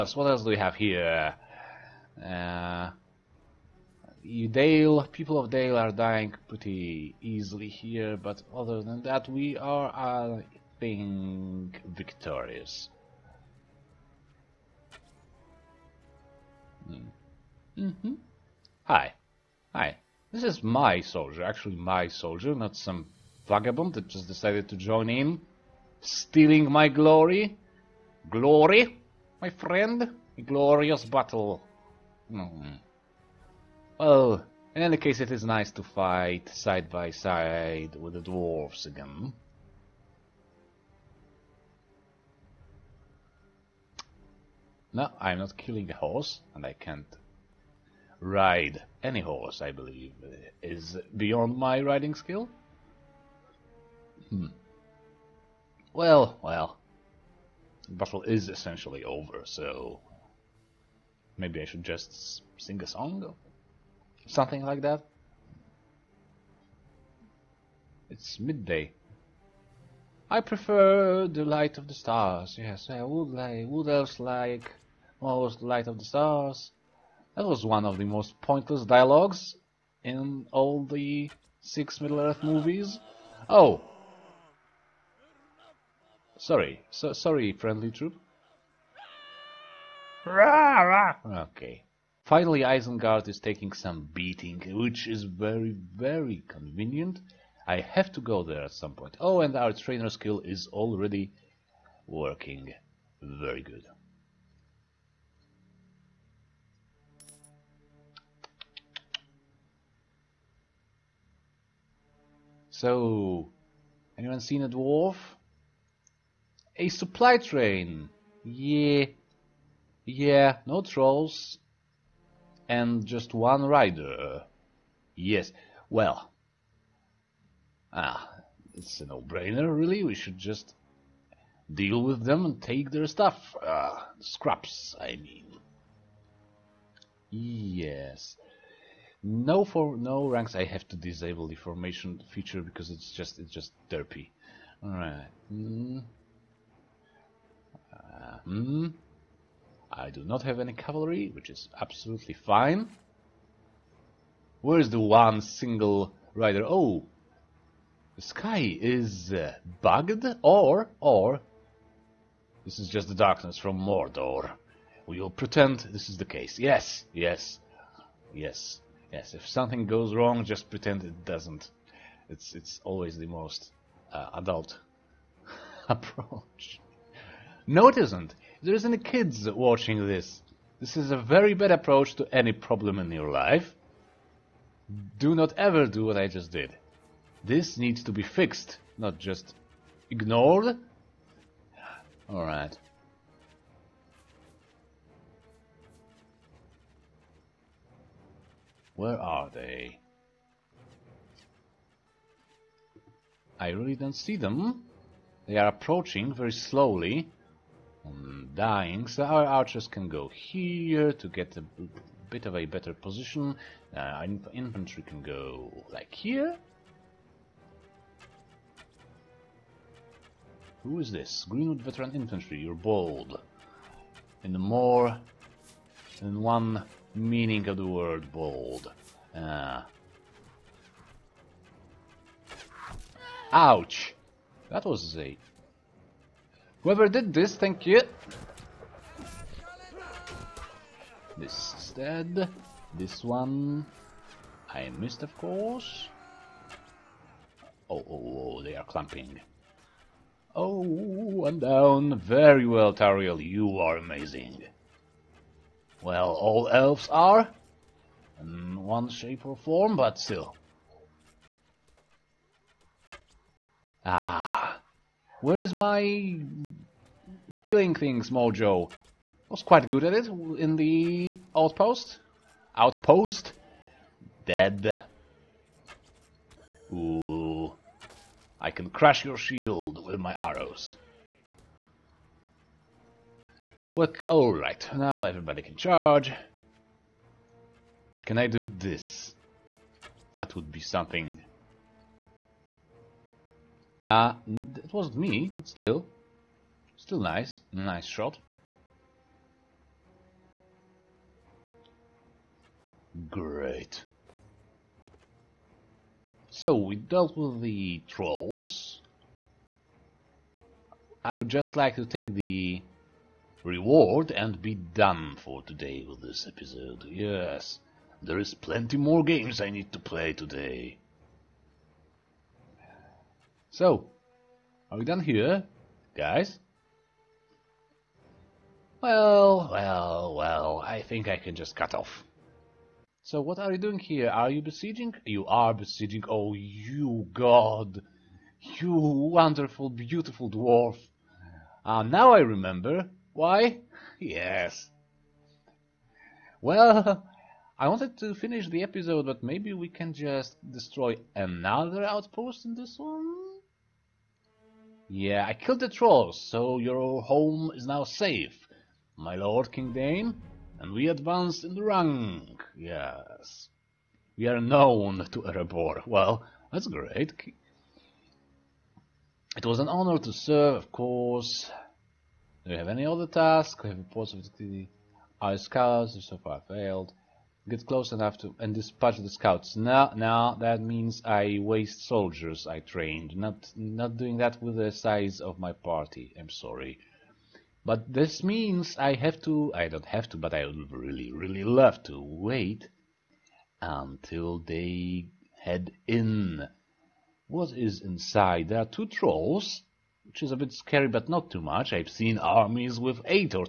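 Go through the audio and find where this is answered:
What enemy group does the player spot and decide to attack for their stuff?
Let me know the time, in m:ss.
1:56.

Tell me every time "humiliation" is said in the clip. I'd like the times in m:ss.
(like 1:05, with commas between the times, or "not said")
not said.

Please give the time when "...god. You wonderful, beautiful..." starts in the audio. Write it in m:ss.
5:37.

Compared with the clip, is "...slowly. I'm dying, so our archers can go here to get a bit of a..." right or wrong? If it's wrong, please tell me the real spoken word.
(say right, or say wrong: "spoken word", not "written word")
right.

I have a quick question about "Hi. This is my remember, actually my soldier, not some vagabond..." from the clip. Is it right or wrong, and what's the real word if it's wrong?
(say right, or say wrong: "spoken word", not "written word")
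wrong: "soldier", not "remember".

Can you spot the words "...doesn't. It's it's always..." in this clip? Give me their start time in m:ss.
2:51.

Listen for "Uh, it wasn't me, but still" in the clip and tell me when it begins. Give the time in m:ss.
4:54.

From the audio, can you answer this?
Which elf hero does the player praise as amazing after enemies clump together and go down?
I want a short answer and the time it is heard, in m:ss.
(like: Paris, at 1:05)
Tauriel, at 4:12.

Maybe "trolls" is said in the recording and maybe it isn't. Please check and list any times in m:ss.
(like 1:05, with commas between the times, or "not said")
2:00, 5:08, 5:55, 6:39.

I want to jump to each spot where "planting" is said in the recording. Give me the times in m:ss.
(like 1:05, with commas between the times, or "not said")
not said.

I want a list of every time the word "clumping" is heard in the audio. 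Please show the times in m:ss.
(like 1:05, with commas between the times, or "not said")
4:08.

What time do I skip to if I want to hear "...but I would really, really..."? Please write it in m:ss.
6:30.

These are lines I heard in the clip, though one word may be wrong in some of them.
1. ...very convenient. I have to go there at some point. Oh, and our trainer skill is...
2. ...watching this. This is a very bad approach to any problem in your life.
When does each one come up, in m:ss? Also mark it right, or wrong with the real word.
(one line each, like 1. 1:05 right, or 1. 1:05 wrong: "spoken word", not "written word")
1. 1:35 right
2. 2:59 right.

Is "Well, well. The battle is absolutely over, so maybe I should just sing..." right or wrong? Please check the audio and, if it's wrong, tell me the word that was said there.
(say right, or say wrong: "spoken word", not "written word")
wrong: "essentially", not "absolutely".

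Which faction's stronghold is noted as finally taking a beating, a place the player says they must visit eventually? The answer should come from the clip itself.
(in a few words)
Isengard.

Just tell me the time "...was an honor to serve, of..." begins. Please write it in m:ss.
6:09.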